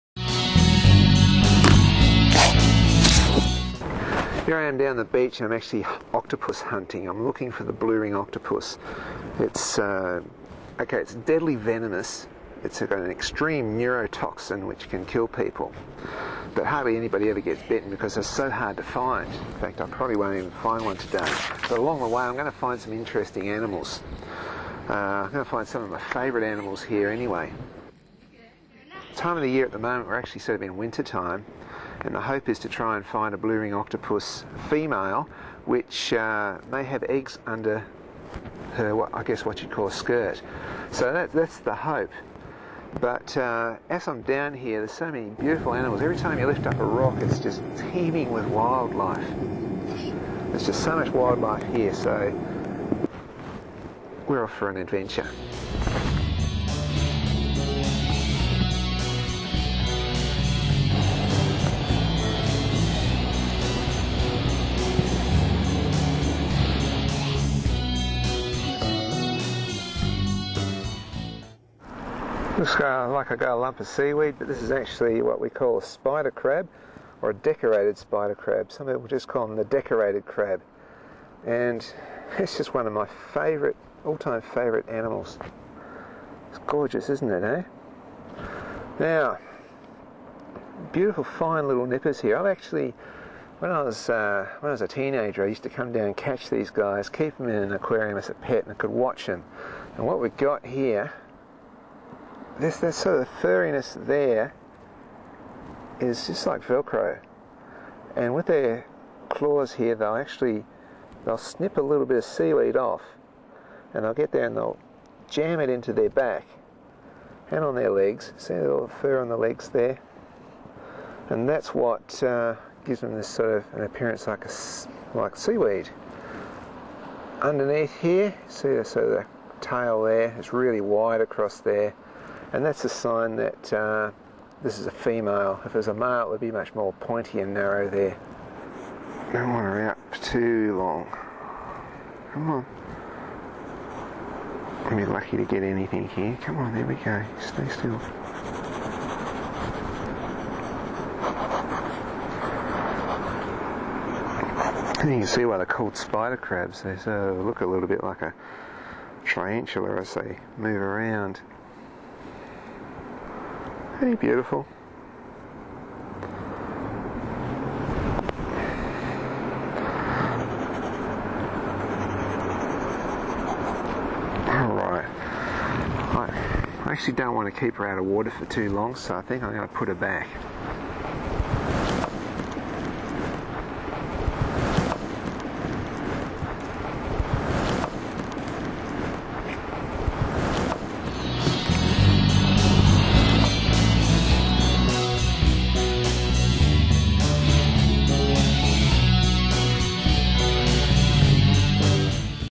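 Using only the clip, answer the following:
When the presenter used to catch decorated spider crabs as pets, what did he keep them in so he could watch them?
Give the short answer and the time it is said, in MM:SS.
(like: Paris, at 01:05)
an aquarium, at 01:37.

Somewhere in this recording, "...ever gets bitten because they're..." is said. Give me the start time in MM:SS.
00:17.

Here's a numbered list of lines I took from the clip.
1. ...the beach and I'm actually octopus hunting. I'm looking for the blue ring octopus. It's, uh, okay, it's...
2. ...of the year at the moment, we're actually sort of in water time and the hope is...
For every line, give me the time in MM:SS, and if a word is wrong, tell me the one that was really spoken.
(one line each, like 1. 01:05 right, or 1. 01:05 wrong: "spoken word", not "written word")
1. 00:04 right
2. 00:29 wrong: "winter", not "water".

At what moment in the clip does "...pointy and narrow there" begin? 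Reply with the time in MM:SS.
02:16.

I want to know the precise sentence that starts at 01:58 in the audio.
See the little fur on the legs there?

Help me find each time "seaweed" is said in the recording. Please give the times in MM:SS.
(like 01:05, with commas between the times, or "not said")
01:13, 01:52, 02:05.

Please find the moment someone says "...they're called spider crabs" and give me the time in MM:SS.
02:35.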